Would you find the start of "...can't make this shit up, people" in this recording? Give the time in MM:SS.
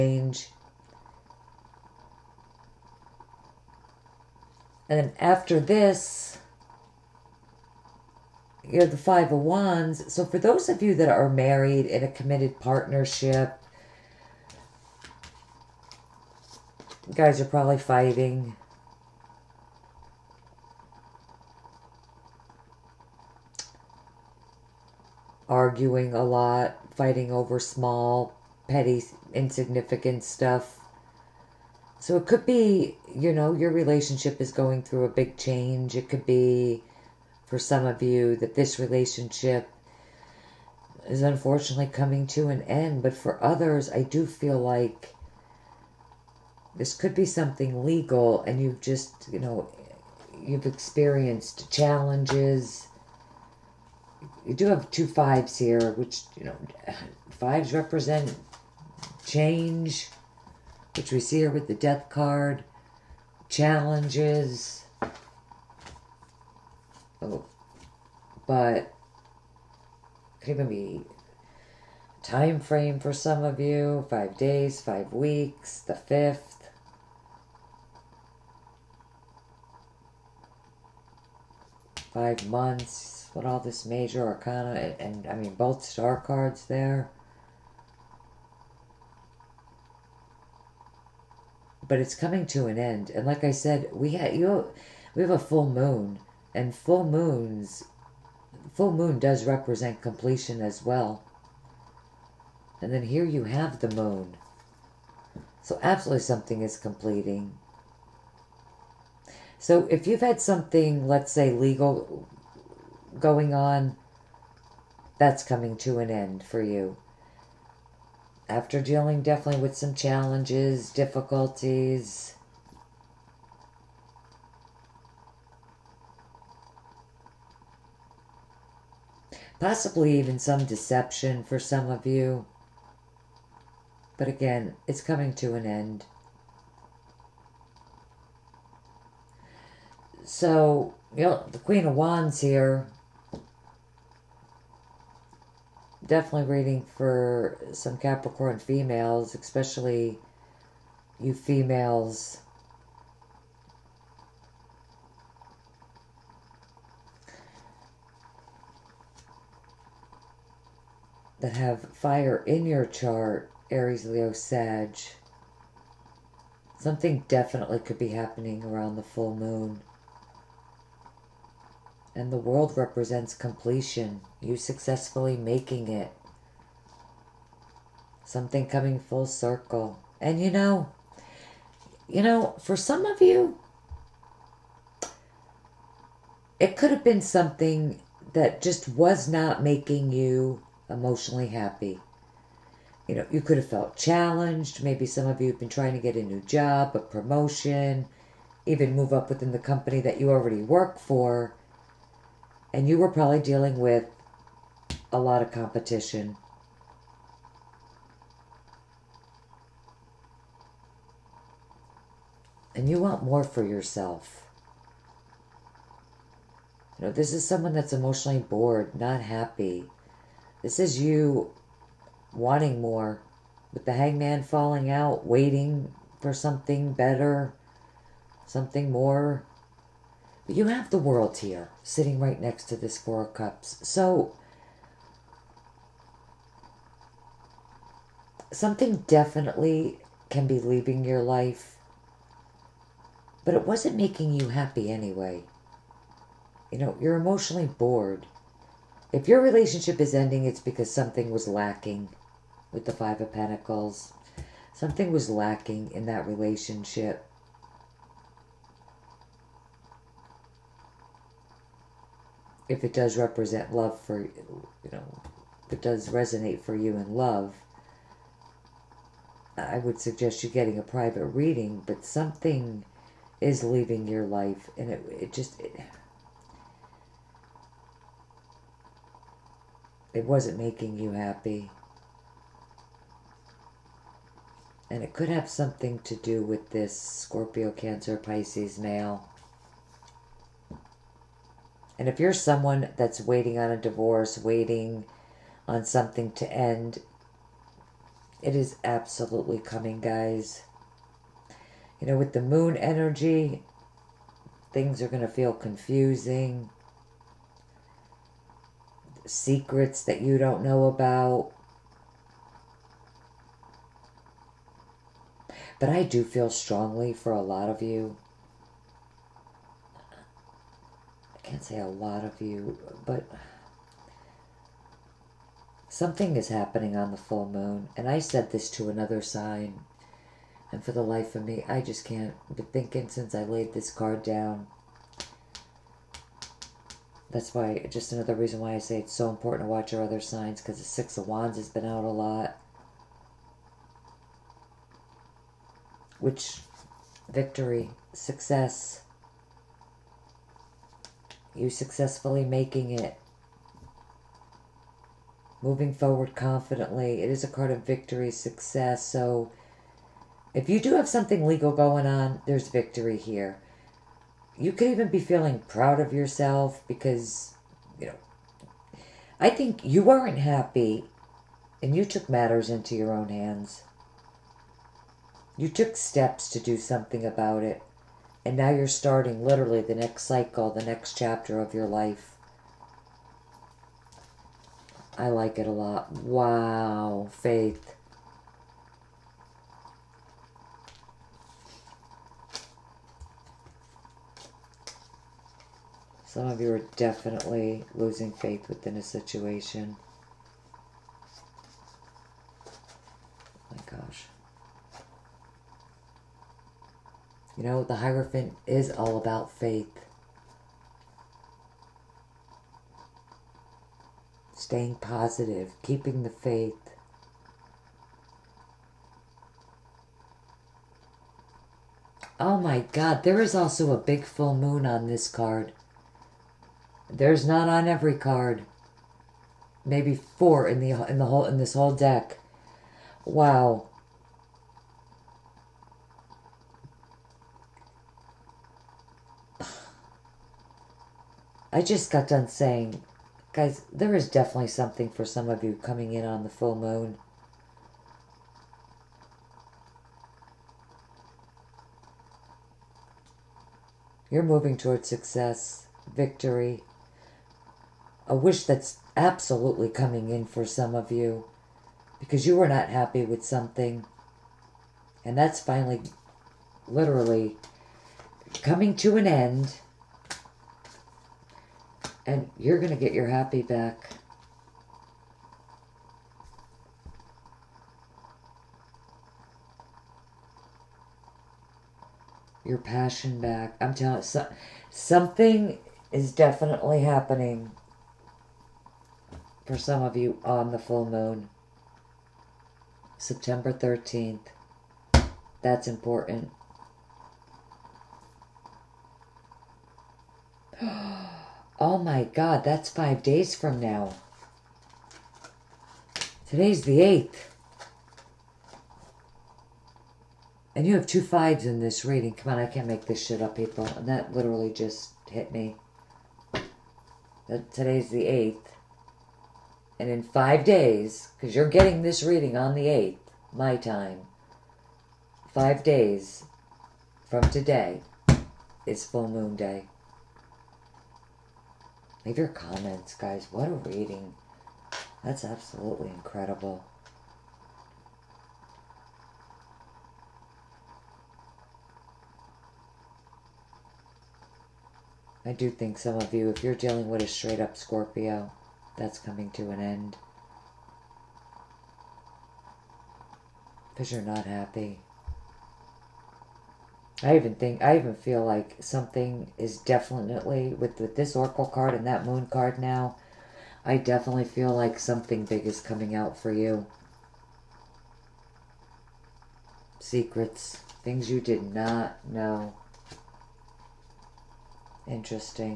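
08:32.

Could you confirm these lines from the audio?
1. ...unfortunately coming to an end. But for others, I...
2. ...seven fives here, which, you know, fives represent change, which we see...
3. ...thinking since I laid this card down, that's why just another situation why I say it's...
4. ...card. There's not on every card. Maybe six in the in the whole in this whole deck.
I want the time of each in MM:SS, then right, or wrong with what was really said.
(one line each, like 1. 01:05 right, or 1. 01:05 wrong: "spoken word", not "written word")
1. 00:41 right
2. 00:54 wrong: "two", not "seven"
3. 05:32 wrong: "reason", not "situation"
4. 07:05 wrong: "four", not "six".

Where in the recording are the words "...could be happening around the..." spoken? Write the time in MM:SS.
02:47.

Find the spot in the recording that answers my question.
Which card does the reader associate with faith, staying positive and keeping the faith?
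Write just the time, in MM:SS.
06:47.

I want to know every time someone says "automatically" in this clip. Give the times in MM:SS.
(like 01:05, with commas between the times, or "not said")
not said.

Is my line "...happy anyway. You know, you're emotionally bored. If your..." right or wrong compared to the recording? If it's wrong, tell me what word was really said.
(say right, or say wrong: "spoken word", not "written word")
right.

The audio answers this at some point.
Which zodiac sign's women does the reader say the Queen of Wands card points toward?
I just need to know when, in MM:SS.
02:27.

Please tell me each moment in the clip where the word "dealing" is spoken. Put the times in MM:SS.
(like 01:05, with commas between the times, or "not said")
01:58, 03:23, 09:06.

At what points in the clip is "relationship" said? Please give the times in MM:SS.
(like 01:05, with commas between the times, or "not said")
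00:33, 00:38, 04:09, 04:16.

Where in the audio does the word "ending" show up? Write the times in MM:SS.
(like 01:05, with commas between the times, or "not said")
04:10.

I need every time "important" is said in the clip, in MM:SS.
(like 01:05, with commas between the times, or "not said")
05:39, 08:15.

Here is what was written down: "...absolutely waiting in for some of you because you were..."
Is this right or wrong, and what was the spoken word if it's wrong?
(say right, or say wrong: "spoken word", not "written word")
wrong: "coming", not "waiting".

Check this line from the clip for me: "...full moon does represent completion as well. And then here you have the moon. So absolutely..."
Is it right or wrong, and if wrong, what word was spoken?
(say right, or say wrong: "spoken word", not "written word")
right.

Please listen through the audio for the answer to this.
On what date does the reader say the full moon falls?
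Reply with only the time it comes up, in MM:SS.
08:13.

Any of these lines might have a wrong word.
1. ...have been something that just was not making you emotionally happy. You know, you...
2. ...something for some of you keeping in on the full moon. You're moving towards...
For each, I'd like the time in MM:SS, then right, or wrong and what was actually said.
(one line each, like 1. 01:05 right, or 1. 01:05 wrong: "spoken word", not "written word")
1. 03:06 right
2. 07:24 wrong: "coming", not "keeping".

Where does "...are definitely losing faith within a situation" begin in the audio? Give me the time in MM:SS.
06:36.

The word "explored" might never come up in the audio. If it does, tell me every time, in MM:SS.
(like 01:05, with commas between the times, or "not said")
not said.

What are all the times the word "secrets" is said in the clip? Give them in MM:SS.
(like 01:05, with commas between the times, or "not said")
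05:09, 09:29.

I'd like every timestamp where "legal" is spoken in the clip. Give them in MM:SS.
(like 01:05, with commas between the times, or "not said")
00:47, 01:51, 06:01.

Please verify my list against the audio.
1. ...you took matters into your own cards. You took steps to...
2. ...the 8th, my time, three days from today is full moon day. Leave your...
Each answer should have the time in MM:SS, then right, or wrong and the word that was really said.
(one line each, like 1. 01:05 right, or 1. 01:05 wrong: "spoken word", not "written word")
1. 06:11 wrong: "hands", not "cards"
2. 08:42 wrong: "five", not "three".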